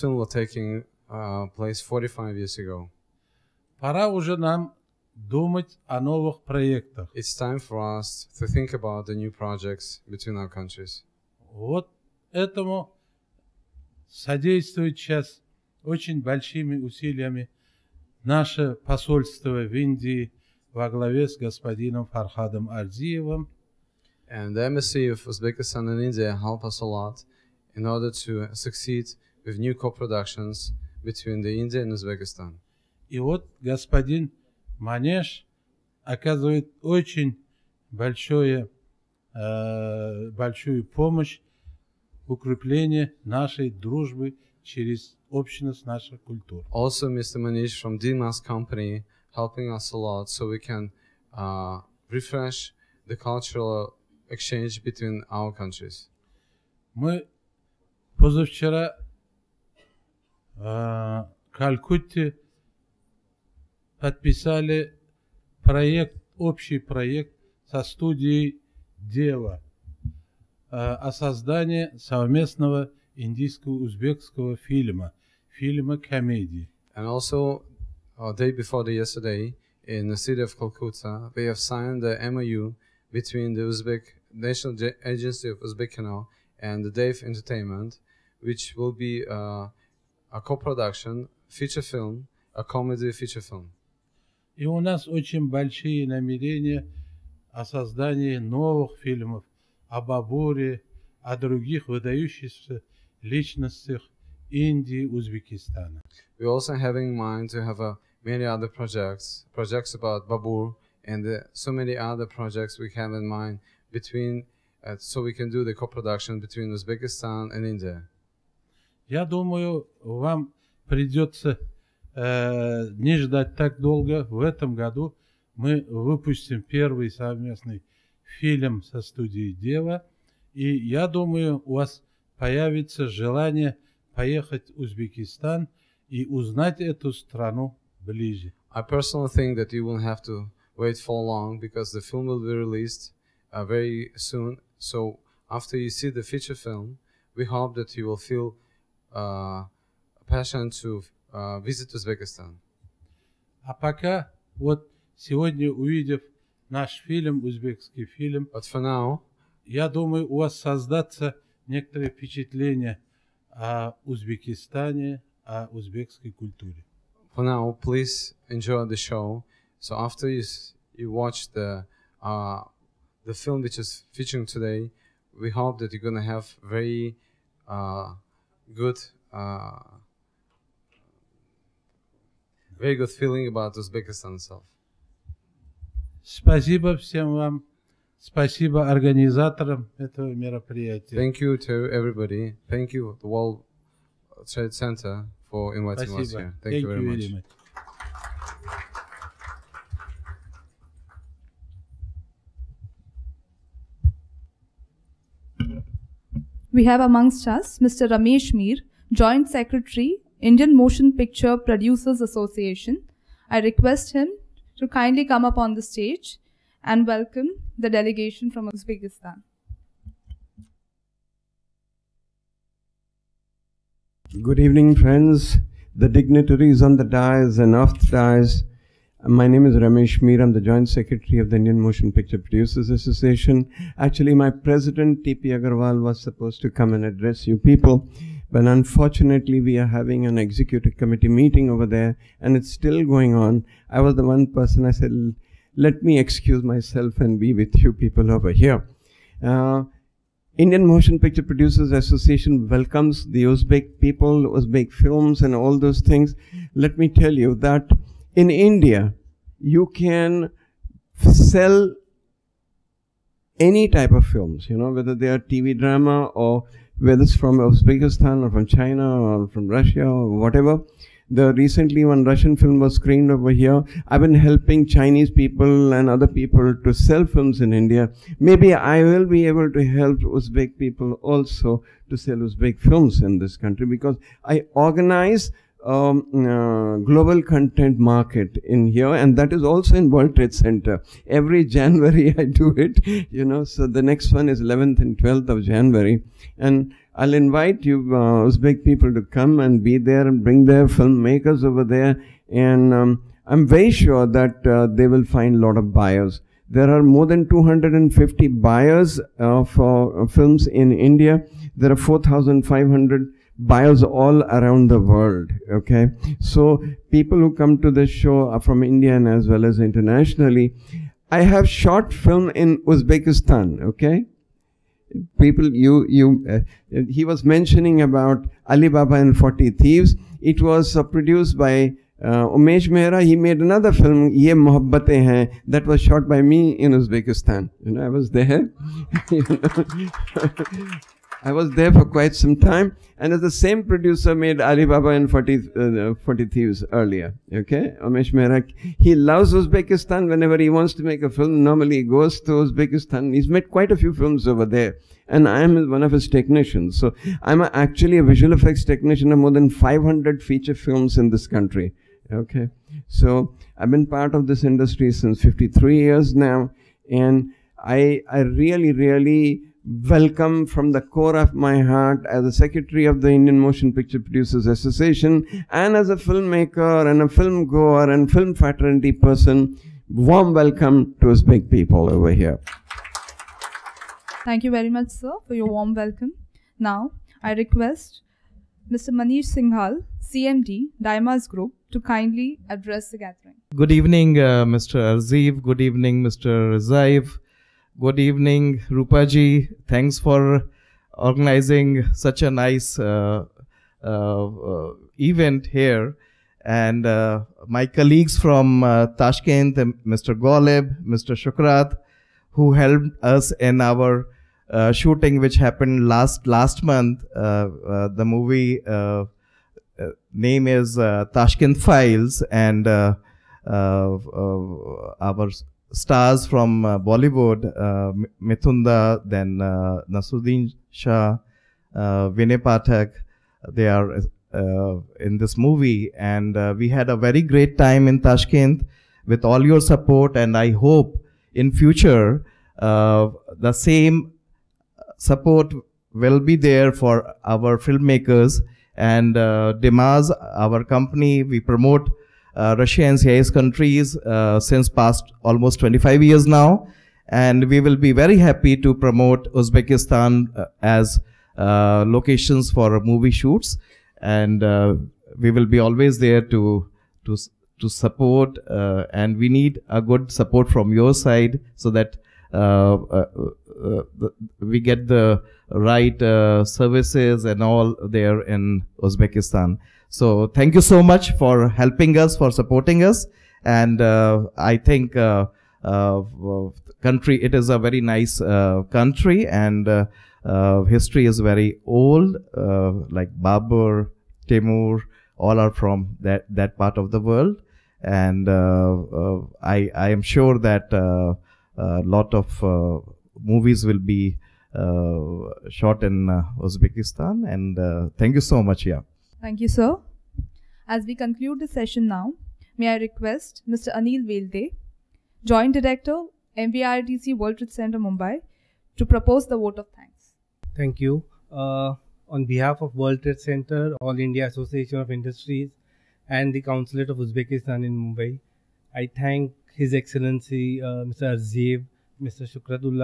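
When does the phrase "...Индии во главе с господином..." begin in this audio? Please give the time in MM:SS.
00:19.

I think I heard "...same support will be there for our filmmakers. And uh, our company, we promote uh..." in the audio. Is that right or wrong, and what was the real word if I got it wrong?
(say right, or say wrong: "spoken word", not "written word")
right.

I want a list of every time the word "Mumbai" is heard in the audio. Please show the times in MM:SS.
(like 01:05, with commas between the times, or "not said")
08:37, 08:47.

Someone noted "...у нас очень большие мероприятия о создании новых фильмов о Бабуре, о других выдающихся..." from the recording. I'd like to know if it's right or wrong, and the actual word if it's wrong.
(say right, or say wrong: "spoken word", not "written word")
wrong: "намерения", not "мероприятия".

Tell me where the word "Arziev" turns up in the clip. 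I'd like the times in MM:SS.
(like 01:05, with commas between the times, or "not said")
06:34, 08:51.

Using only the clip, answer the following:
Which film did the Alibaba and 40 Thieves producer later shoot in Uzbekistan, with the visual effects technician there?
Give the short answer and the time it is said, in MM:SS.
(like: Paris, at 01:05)
Ye Mohabbatein Hain, at 05:34.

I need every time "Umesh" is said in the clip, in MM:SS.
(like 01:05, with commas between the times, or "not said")
05:32, 05:48.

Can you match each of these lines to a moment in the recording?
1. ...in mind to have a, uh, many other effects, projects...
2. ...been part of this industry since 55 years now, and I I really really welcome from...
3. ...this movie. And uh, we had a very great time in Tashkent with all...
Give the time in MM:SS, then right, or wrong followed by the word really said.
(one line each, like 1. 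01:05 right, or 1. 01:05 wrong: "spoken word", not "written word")
1. 01:46 wrong: "projects", not "effects"
2. 06:03 wrong: "53", not "55"
3. 07:15 right.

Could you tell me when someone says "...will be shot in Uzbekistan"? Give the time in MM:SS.
08:23.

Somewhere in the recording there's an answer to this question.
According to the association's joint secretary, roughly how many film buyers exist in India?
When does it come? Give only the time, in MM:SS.
05:07.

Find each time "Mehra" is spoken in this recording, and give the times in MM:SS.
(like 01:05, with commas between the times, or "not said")
05:32, 05:48.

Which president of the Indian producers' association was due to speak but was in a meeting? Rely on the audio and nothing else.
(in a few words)
T.P. Agarwal.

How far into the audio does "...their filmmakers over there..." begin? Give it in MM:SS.
05:00.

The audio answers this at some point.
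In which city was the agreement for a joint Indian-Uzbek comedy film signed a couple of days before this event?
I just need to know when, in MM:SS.
01:20.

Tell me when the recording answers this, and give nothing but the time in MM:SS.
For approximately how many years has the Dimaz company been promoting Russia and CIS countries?
07:35.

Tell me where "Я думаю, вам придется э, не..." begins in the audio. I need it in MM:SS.
01:59.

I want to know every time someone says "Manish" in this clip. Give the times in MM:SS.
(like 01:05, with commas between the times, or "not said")
00:47, 06:29.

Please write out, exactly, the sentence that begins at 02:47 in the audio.
For now, please enjoy the show.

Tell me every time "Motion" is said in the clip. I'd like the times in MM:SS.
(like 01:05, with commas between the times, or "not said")
03:30, 03:51, 04:10, 06:13.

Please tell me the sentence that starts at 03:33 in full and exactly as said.
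I request him to kindly come up on the stage and welcome the delegation from Uzbekistan.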